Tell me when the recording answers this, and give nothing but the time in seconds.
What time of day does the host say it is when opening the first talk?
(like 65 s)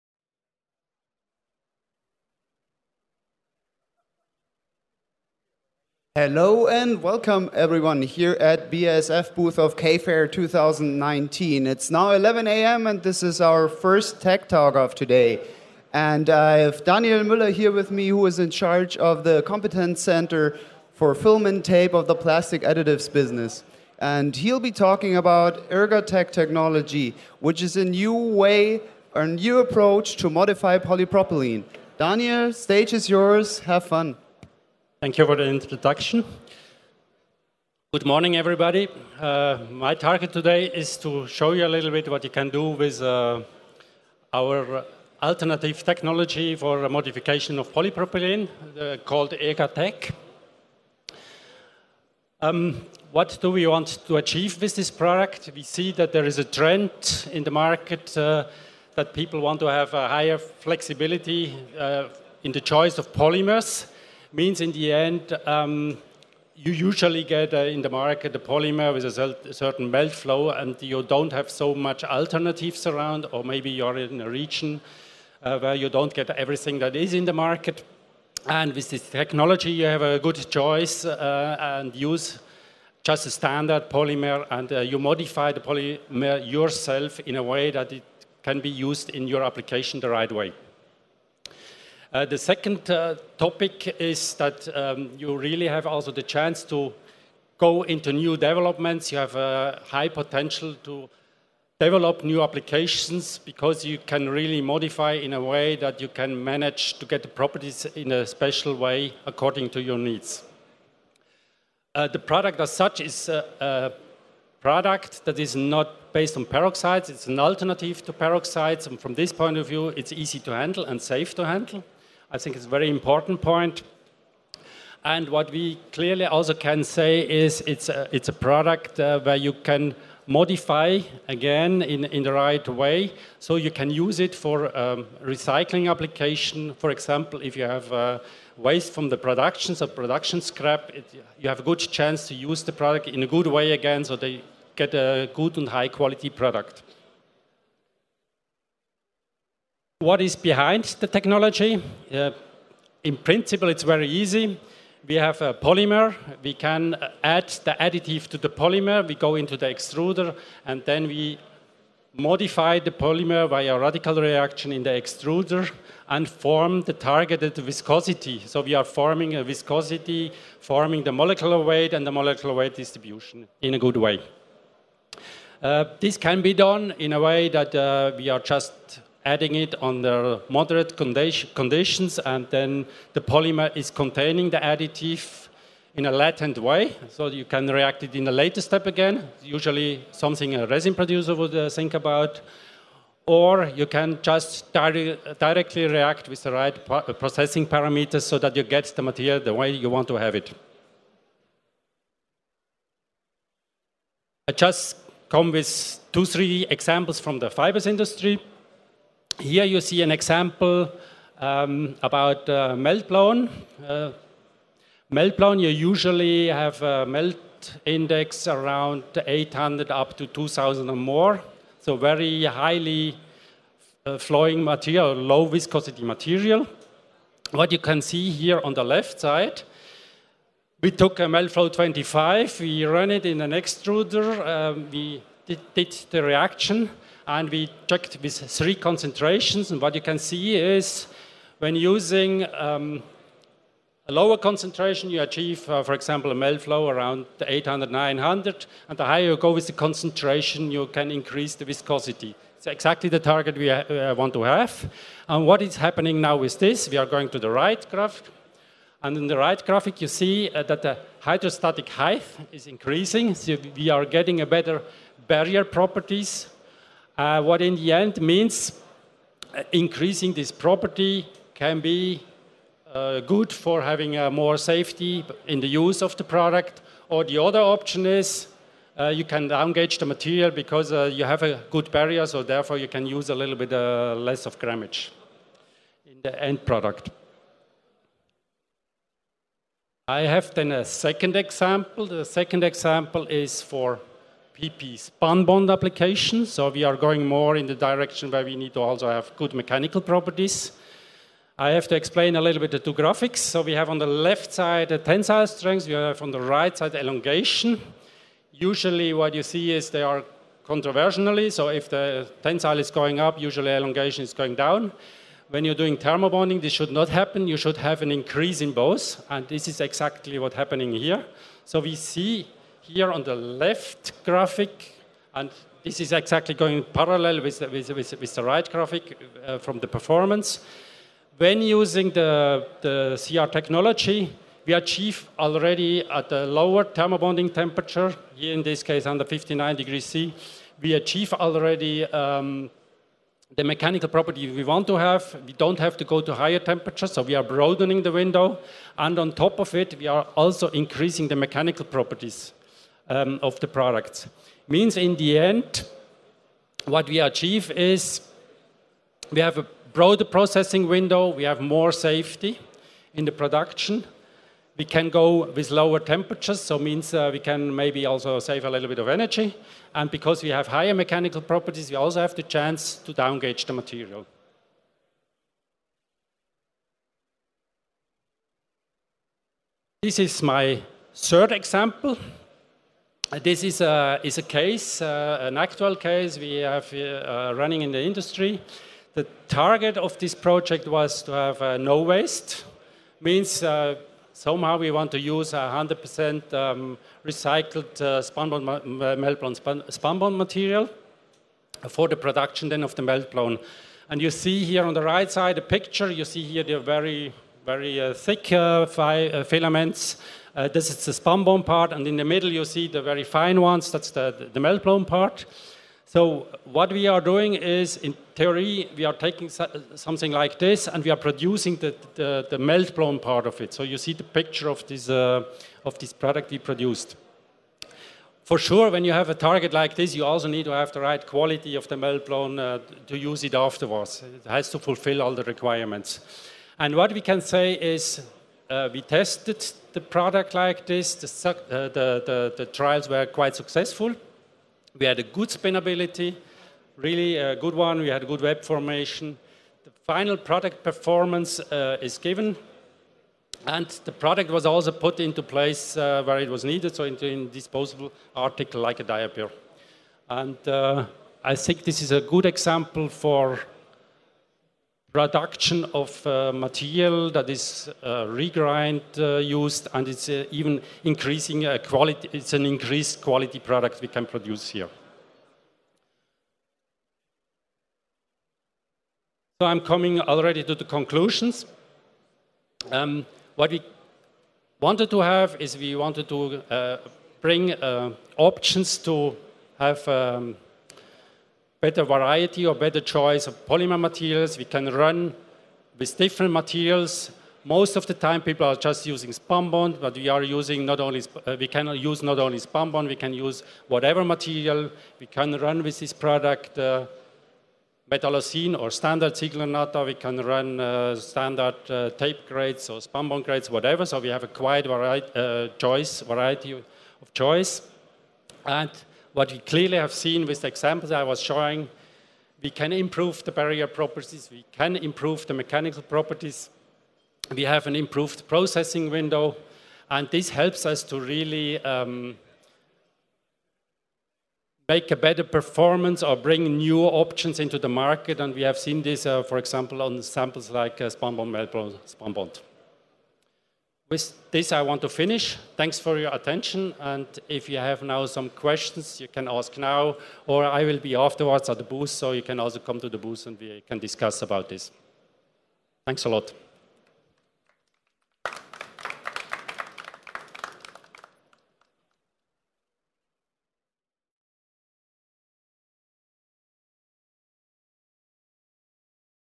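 12 s.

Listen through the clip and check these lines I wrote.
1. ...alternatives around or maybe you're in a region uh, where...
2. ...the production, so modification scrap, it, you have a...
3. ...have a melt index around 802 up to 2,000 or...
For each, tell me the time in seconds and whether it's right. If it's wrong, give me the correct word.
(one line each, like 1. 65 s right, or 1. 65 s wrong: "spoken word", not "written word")
1. 72 s right
2. 139 s wrong: "production", not "modification"
3. 216 s wrong: "800", not "802".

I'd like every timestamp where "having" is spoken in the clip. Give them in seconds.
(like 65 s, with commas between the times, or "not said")
273 s.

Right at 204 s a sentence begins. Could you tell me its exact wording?
I just come with two, three examples from the fibers industry.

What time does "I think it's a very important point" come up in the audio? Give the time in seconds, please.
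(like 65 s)
122 s.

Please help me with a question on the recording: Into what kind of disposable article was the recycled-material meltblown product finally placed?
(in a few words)
A diaper.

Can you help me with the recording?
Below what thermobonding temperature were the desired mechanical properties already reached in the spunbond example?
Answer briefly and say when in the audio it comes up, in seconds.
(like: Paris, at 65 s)
59 degrees C, at 339 s.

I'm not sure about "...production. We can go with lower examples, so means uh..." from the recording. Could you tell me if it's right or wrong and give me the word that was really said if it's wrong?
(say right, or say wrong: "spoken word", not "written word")
wrong: "temperatures", not "examples".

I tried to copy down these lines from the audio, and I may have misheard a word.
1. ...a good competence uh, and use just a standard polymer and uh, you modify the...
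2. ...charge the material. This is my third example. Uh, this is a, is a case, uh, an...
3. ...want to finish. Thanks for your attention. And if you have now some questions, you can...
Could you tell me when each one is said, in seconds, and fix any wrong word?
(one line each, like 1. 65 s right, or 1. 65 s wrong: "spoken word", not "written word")
1. 80 s wrong: "choice", not "competence"
2. 373 s wrong: "downgauge", not "charge"
3. 544 s right.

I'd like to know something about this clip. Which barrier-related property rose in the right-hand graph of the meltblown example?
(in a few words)
Hydrostatic height.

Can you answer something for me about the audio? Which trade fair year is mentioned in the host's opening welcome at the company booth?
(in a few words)
2019.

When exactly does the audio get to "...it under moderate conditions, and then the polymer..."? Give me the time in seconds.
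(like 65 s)
179 s.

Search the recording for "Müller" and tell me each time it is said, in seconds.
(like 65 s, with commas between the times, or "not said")
17 s.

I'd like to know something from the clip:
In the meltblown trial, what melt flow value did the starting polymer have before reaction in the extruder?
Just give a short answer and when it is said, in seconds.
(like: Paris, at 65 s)
25, at 231 s.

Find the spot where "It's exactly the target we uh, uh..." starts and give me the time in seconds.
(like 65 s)
252 s.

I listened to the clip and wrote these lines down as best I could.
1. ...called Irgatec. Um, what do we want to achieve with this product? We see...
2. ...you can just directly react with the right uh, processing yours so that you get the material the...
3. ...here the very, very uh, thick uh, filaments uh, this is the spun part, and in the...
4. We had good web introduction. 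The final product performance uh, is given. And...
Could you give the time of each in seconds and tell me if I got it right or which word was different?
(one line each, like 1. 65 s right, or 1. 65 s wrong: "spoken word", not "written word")
1. 48 s right
2. 193 s wrong: "parameters", not "yours"
3. 406 s right
4. 447 s wrong: "formation", not "introduction".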